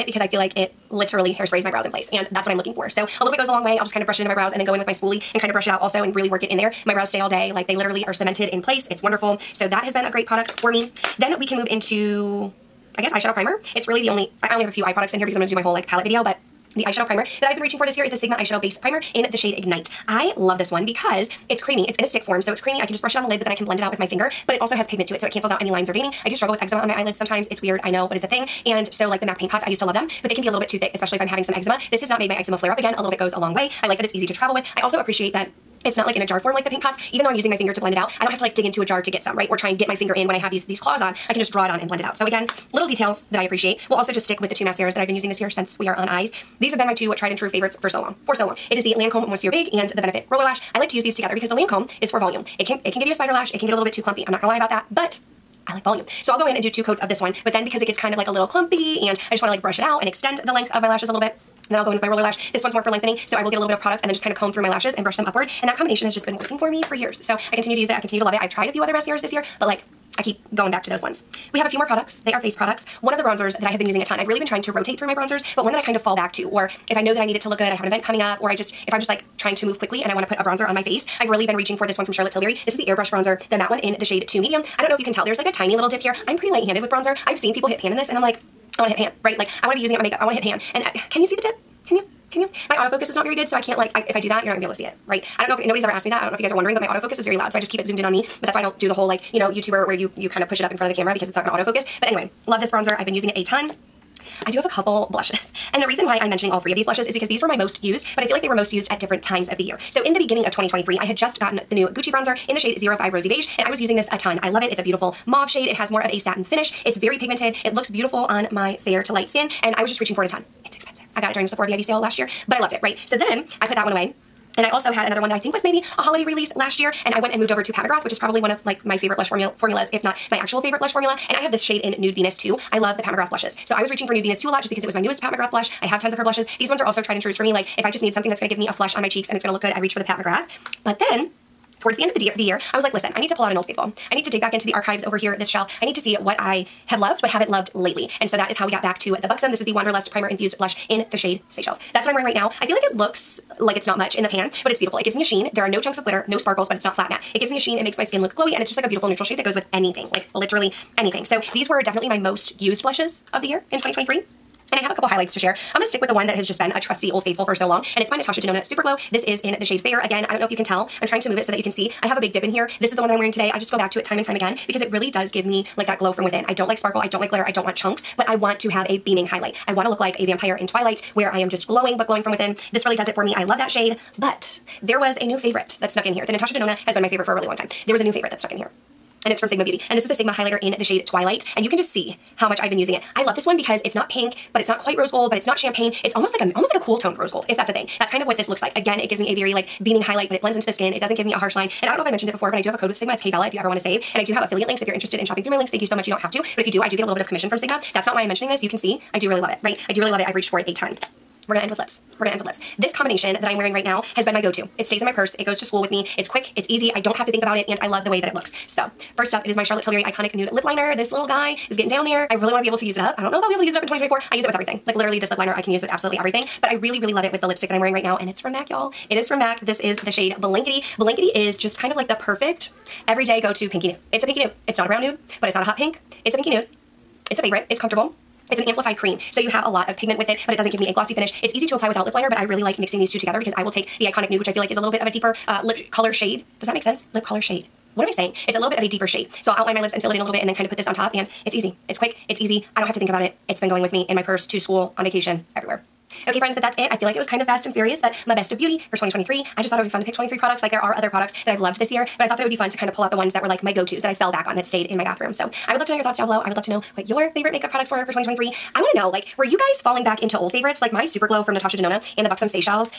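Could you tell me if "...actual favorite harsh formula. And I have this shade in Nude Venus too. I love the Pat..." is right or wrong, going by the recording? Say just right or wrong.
wrong.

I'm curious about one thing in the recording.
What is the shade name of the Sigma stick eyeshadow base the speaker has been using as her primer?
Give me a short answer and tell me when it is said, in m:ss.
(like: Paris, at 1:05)
Ignite, at 0:19.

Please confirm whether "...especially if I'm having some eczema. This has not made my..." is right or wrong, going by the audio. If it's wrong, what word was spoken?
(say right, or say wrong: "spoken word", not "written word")
right.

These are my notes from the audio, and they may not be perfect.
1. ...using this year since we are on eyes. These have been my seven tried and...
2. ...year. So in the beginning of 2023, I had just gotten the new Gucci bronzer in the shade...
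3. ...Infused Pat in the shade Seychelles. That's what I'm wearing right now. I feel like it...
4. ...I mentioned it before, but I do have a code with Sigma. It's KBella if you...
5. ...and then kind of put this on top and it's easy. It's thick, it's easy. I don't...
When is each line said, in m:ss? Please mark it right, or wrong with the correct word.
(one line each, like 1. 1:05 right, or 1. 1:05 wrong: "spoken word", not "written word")
1. 0:45 wrong: "two", not "seven"
2. 1:49 right
3. 2:30 wrong: "Blush", not "Pat"
4. 3:22 right
5. 4:10 wrong: "quick", not "thick".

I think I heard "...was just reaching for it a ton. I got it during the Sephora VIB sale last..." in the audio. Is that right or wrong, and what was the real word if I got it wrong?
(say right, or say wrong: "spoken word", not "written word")
right.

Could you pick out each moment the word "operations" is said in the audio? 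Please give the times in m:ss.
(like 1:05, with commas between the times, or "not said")
not said.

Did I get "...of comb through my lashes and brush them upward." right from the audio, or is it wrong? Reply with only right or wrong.
right.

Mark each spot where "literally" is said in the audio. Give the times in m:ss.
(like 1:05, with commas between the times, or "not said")
0:00, 0:07, 2:40, 3:44.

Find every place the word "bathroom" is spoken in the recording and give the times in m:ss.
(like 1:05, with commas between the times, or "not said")
4:25.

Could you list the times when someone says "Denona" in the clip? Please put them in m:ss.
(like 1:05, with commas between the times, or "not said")
2:48, 3:06, 4:31.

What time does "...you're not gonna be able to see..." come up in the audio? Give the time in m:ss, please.
1:34.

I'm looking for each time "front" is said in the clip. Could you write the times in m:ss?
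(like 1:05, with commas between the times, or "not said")
1:40.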